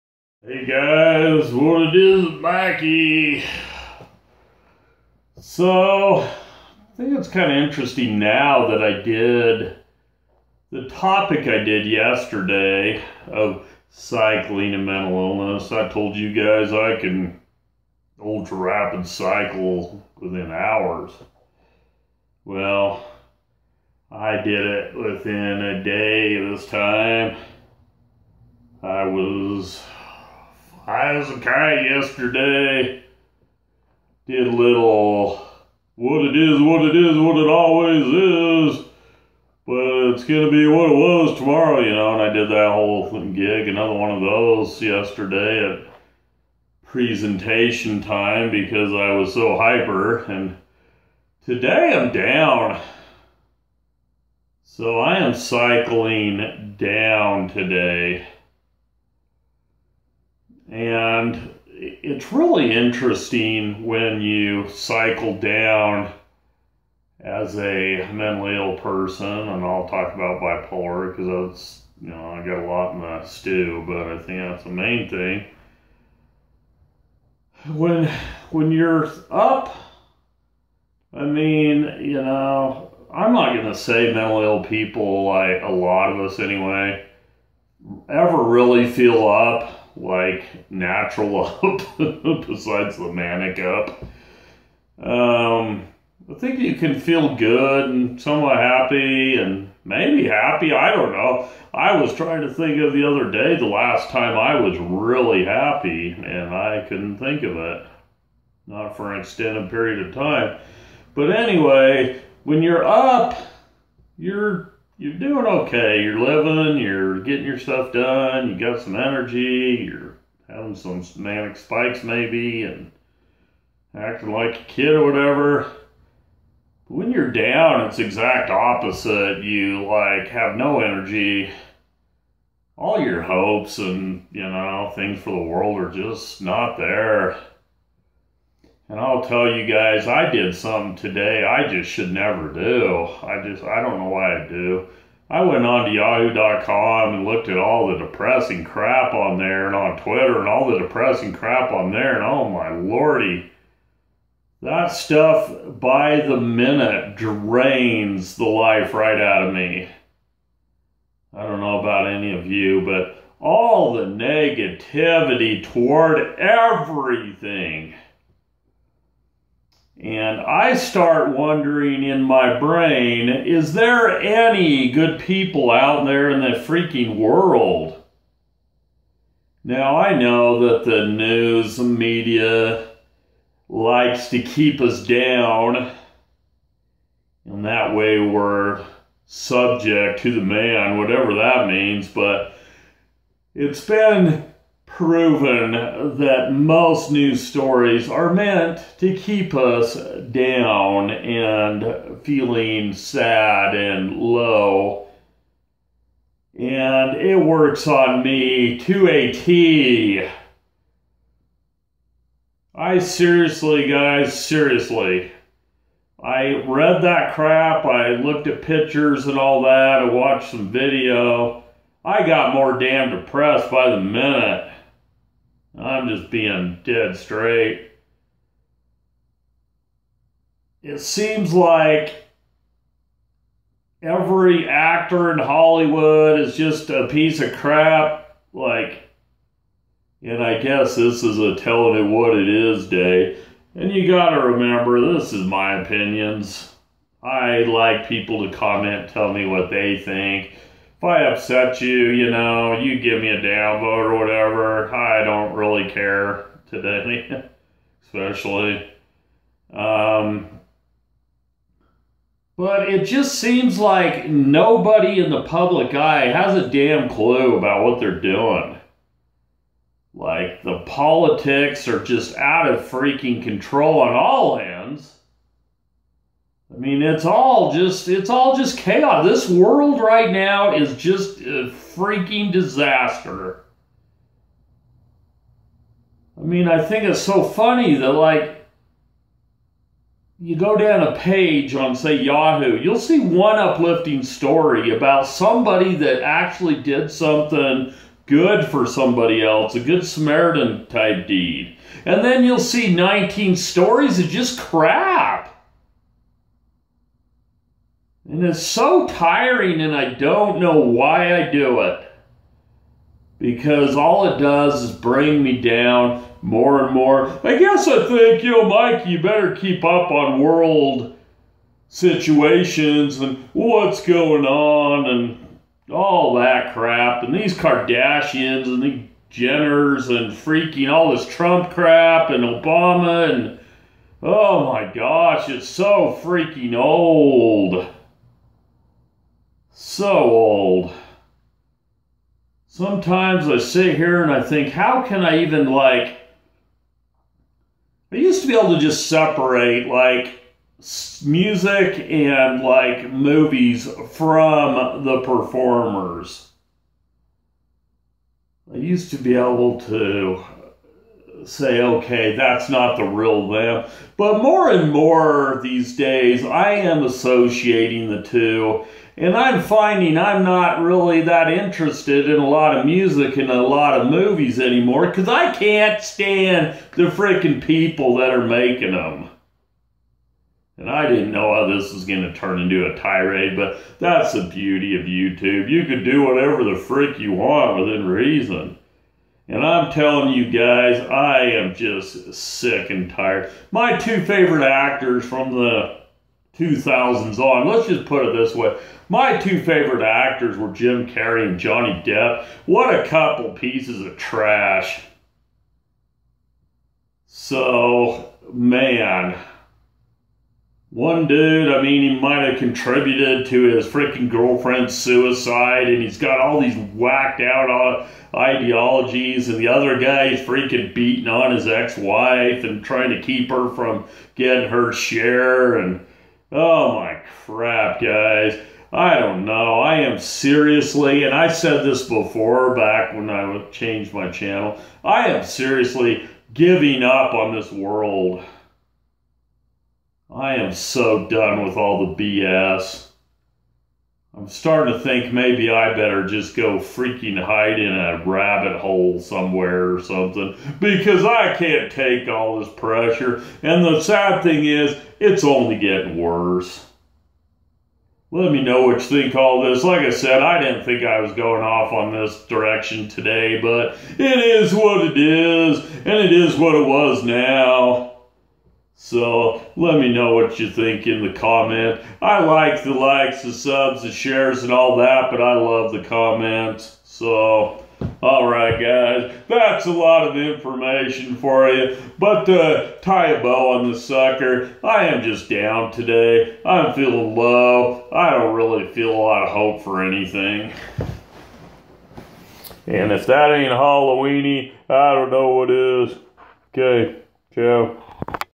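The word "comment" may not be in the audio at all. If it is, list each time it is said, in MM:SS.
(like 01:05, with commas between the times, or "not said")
04:08, 07:51, 07:56.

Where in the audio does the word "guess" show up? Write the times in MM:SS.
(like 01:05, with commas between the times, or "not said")
04:00, 05:17.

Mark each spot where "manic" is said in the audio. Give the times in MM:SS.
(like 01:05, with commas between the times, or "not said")
01:33, 02:01.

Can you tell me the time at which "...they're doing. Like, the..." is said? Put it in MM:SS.
04:27.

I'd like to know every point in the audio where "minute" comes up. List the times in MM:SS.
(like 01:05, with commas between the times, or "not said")
02:36, 03:43.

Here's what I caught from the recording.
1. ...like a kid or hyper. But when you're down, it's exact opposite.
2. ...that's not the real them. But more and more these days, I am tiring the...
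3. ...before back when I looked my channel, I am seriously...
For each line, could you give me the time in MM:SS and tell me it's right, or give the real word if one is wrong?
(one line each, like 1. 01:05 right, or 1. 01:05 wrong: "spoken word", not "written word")
1. 02:04 wrong: "whatever", not "hyper"
2. 06:02 wrong: "associating", not "tiring"
3. 07:12 wrong: "changed", not "looked".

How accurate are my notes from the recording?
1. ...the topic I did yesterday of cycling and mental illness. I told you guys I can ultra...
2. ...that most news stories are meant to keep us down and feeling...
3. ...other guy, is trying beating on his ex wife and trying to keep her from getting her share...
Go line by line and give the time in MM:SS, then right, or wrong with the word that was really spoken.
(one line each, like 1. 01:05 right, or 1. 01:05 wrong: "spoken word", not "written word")
1. 00:10 right
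2. 03:16 right
3. 06:59 wrong: "freaking", not "trying".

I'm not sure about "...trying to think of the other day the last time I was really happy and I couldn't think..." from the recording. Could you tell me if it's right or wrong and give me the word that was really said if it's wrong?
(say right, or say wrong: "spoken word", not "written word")
right.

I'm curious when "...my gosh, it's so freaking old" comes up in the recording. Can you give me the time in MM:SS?
05:34.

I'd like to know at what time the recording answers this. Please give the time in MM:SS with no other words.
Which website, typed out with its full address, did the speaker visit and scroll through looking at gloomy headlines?
02:25.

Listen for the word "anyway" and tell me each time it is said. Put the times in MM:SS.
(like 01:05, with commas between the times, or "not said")
01:26, 01:51.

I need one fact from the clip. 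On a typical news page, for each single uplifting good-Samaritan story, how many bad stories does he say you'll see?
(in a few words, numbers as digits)
19.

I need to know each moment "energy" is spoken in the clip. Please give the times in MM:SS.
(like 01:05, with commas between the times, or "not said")
01:58, 02:10.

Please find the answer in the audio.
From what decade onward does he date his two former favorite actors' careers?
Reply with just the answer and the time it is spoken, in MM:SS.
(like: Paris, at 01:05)
2000s, at 06:36.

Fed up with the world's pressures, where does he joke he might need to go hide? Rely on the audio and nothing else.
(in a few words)
a rabbit hole.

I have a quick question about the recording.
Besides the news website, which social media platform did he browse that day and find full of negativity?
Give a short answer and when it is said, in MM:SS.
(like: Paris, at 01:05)
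Twitter, at 02:30.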